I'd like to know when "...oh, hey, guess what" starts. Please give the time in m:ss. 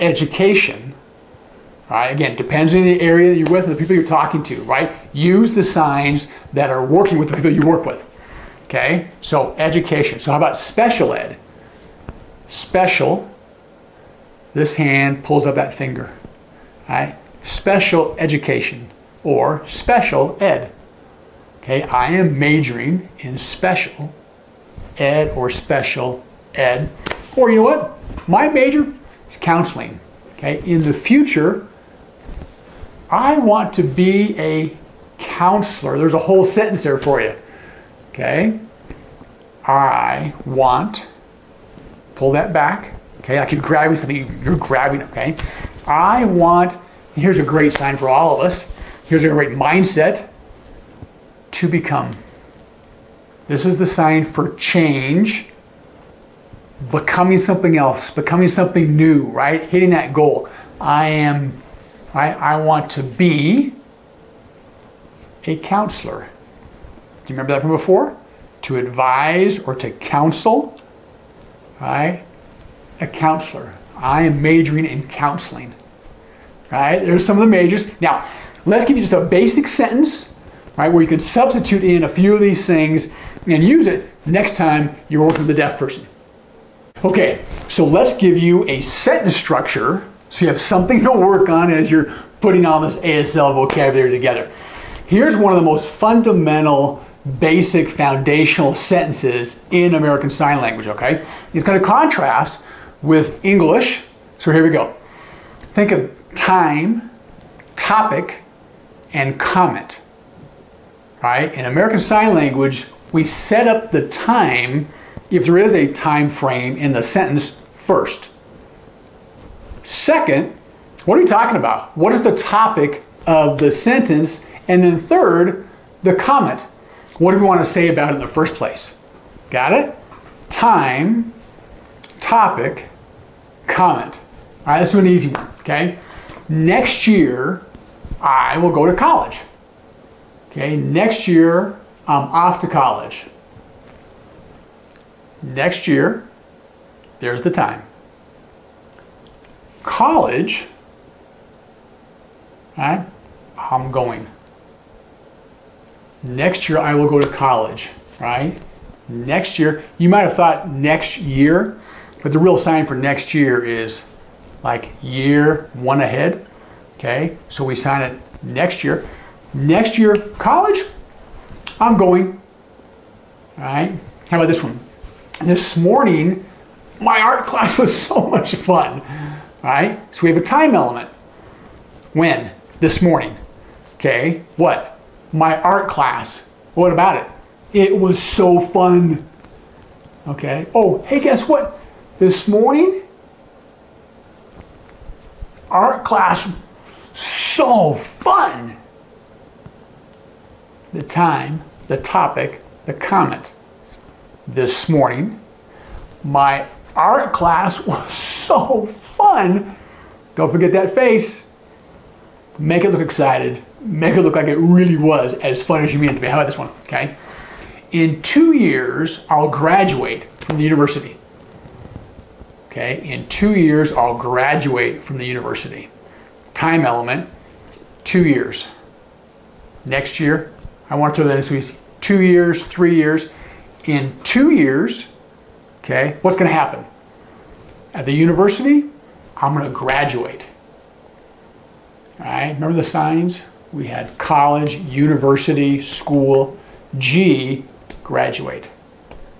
3:10.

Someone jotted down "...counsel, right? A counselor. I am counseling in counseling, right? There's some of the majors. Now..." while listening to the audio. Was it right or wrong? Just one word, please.
wrong.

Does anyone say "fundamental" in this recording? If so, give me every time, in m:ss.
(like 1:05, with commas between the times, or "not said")
1:35.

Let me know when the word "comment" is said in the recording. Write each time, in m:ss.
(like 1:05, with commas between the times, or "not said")
1:49, 2:06, 2:13, 3:22.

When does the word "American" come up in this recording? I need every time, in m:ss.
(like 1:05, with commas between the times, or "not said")
1:39, 1:51.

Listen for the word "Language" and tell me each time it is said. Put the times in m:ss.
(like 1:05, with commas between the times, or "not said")
1:40, 1:52.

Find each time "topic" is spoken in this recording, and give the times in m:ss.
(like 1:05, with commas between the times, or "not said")
1:47, 2:02, 2:12, 3:21.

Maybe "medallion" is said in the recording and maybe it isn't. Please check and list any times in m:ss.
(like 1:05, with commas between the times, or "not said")
not said.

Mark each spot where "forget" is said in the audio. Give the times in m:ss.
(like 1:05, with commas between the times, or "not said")
3:30.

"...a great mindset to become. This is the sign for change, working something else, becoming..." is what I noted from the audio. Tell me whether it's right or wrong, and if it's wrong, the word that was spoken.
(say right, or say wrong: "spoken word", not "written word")
wrong: "becoming", not "working".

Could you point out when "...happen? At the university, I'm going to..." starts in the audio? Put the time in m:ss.
3:56.